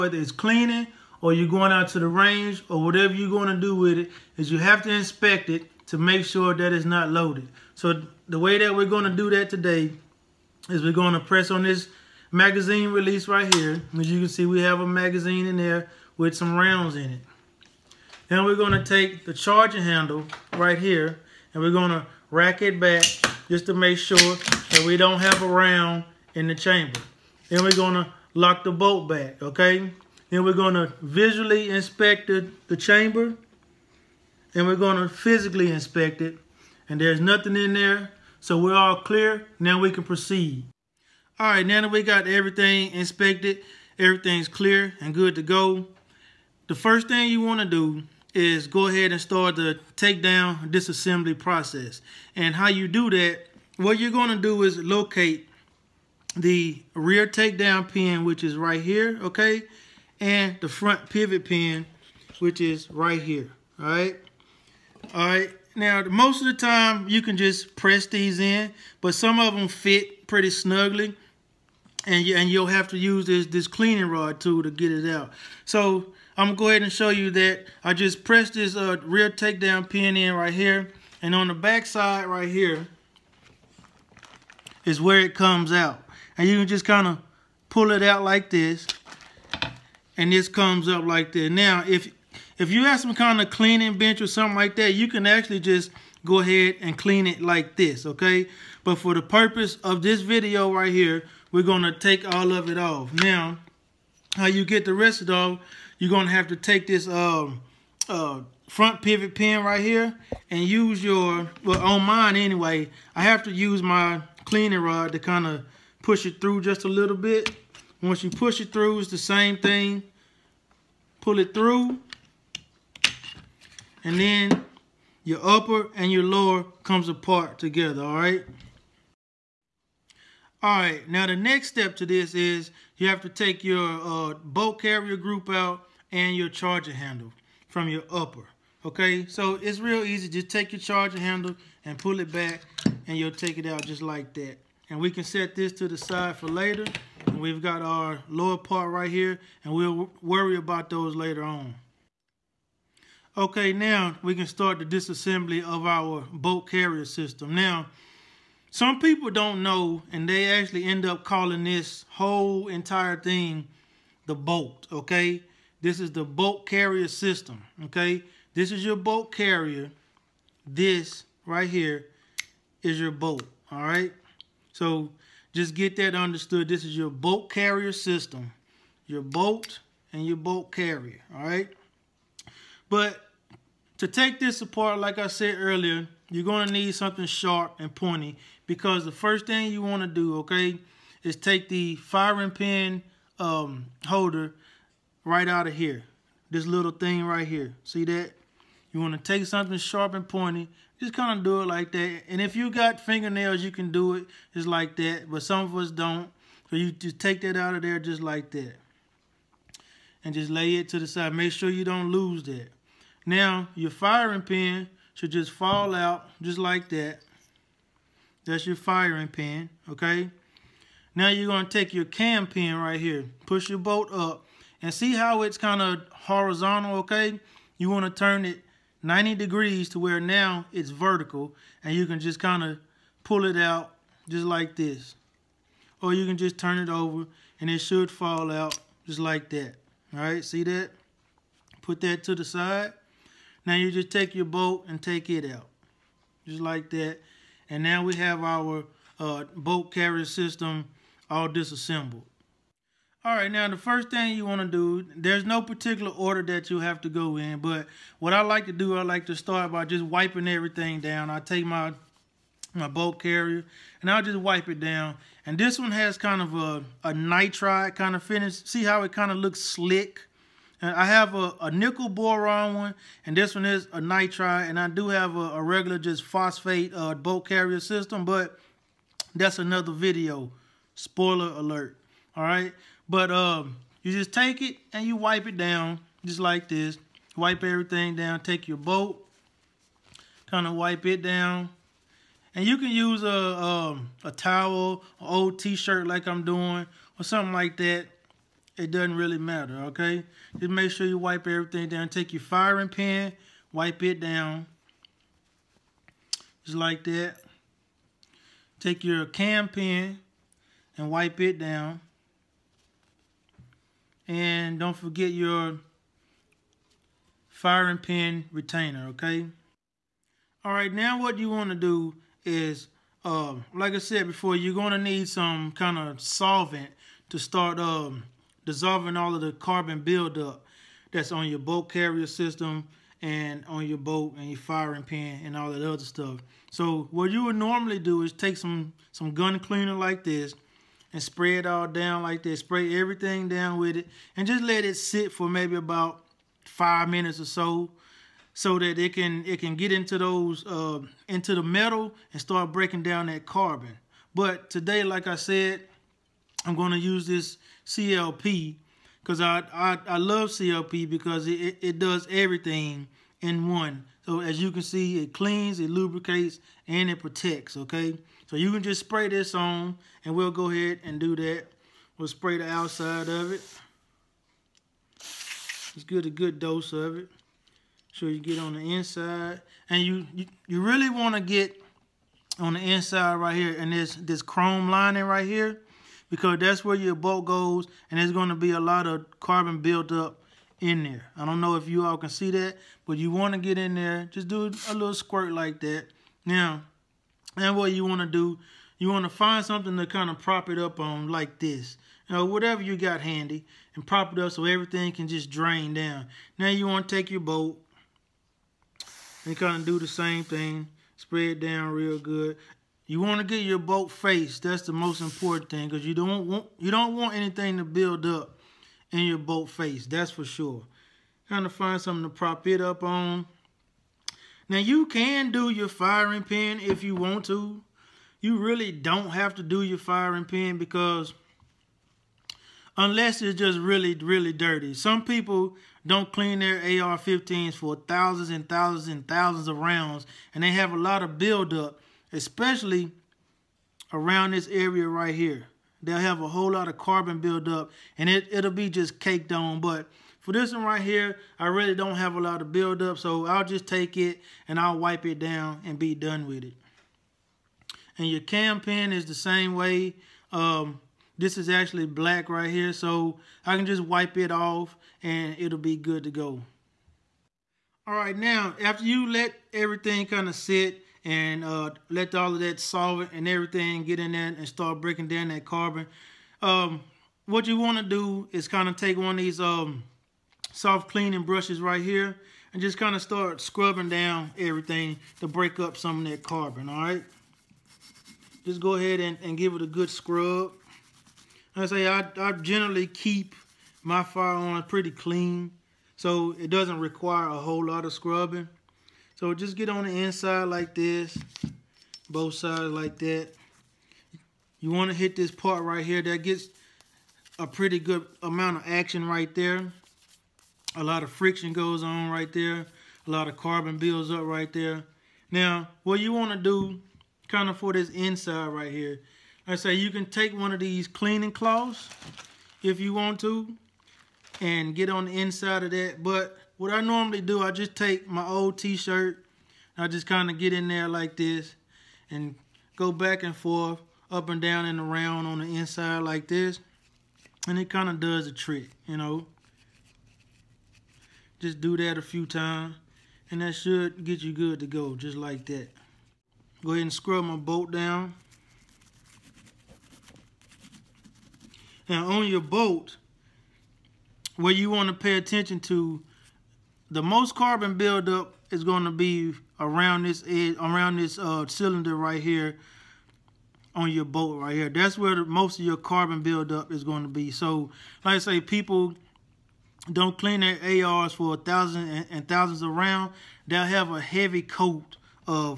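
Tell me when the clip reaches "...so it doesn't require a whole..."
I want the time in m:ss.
8:16.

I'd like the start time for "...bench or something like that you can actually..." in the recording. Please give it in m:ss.
1:33.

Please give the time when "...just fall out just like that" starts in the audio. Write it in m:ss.
3:35.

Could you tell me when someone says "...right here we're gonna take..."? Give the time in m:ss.
1:40.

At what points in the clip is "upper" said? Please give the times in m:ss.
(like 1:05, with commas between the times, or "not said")
2:05, 2:18.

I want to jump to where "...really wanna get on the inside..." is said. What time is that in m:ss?
6:20.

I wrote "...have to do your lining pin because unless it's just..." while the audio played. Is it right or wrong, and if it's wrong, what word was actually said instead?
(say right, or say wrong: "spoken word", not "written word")
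wrong: "firing", not "lining".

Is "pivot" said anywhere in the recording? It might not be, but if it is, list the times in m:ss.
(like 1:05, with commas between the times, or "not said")
1:01, 1:49.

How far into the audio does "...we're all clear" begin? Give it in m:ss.
0:38.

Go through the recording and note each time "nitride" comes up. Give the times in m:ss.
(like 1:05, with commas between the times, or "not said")
4:27, 4:34.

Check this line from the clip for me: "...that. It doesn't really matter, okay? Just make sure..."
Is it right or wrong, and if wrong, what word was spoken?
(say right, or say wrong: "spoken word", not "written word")
right.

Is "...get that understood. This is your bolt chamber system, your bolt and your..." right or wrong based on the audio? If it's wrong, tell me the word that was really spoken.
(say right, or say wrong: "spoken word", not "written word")
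wrong: "carrier", not "chamber".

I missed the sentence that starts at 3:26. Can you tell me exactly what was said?
So you just take that out of there just like that.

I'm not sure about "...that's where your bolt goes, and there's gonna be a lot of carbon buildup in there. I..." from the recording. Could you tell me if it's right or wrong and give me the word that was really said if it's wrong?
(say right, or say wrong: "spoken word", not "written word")
right.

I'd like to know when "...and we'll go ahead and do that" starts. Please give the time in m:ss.
6:10.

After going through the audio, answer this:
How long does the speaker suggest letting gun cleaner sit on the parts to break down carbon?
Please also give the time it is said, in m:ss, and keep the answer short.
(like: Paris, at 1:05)
about 5 minutes, at 5:45.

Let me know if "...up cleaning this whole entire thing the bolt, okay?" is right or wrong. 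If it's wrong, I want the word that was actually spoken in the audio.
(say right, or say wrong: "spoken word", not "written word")
wrong: "calling", not "cleaning".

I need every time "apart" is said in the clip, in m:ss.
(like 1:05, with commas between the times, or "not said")
2:07, 3:04.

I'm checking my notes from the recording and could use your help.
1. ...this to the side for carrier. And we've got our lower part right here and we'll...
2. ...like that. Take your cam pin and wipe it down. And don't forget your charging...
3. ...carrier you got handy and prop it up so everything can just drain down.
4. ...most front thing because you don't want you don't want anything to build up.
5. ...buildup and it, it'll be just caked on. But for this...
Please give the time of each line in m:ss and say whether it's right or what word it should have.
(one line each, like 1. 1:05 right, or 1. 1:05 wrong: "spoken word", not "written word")
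1. 2:25 wrong: "later", not "carrier"
2. 5:06 wrong: "firing", not "charging"
3. 6:42 wrong: "whatever", not "carrier"
4. 6:54 wrong: "important", not "front"
5. 7:27 right.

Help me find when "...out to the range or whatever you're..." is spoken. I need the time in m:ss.
0:01.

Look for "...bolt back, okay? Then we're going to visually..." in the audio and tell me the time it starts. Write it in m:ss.
0:28.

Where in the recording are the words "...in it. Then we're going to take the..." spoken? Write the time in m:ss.
0:16.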